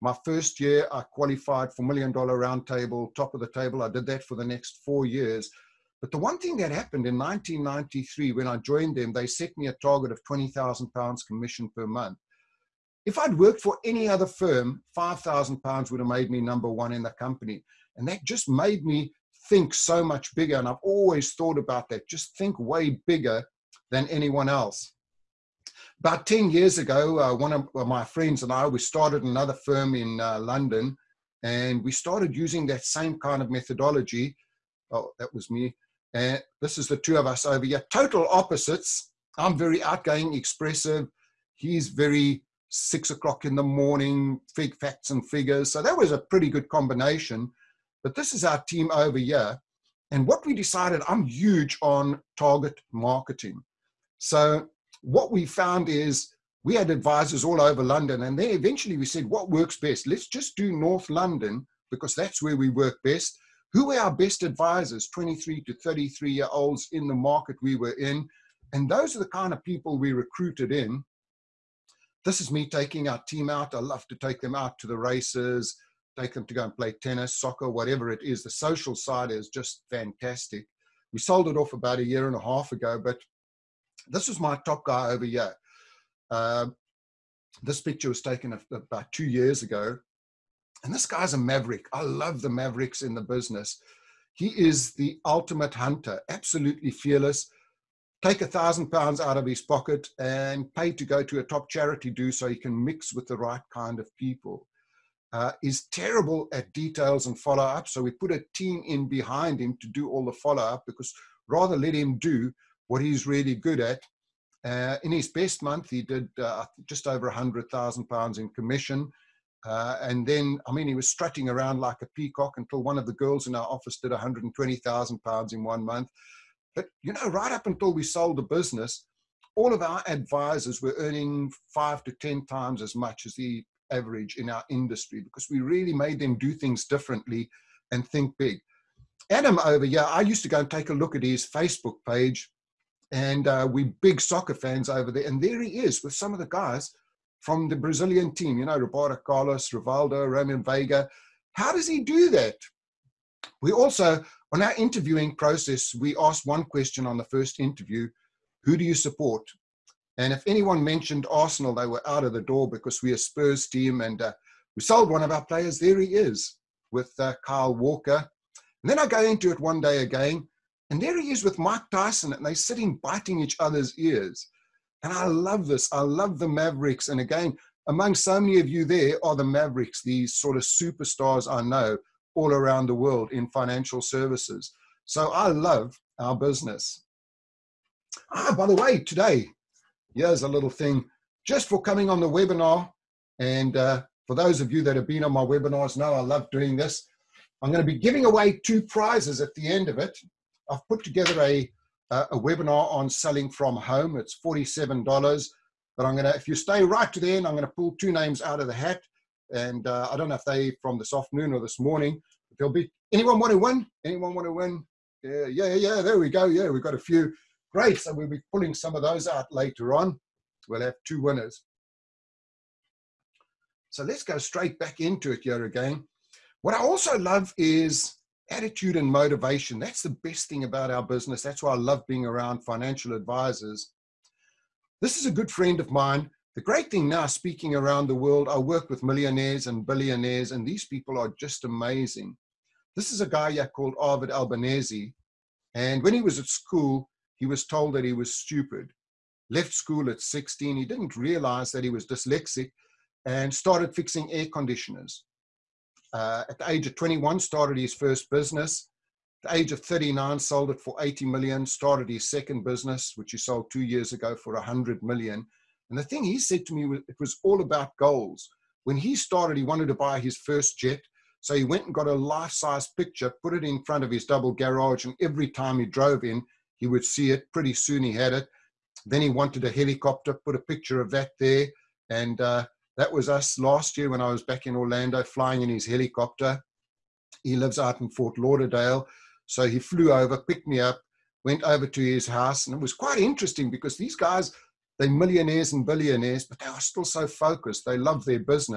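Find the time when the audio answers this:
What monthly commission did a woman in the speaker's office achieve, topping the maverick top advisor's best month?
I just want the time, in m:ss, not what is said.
2:04.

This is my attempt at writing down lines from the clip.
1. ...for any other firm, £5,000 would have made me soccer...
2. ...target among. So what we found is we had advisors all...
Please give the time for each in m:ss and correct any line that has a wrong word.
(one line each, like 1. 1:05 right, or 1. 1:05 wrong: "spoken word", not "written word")
1. 0:13 wrong: "number", not "soccer"
2. 0:52 wrong: "marketing", not "among".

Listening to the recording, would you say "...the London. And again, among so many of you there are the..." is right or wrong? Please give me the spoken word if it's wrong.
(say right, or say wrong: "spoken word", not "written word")
wrong: "Mavericks", not "London".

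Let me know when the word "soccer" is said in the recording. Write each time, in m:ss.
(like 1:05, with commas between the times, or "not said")
1:17, 2:24.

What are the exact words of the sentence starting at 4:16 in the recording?
Uh, at the age of 21, started his first business.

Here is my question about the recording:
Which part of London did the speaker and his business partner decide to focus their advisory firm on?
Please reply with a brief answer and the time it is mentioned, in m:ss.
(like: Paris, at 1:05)
North London, at 1:00.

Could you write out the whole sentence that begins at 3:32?
If there'll be anyone want to win?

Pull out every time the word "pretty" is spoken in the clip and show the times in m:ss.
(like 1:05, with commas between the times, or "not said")
0:46, 4:37.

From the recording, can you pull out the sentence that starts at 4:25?
And the thing he said to me was it was all about goals.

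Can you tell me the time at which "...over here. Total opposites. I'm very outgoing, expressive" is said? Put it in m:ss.
0:37.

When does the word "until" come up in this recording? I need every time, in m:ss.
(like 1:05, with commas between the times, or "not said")
2:02, 2:07.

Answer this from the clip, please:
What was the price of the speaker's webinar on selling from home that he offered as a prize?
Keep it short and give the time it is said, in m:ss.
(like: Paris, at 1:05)
$47, at 3:24.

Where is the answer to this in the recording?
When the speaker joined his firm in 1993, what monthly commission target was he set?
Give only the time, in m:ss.
0:10.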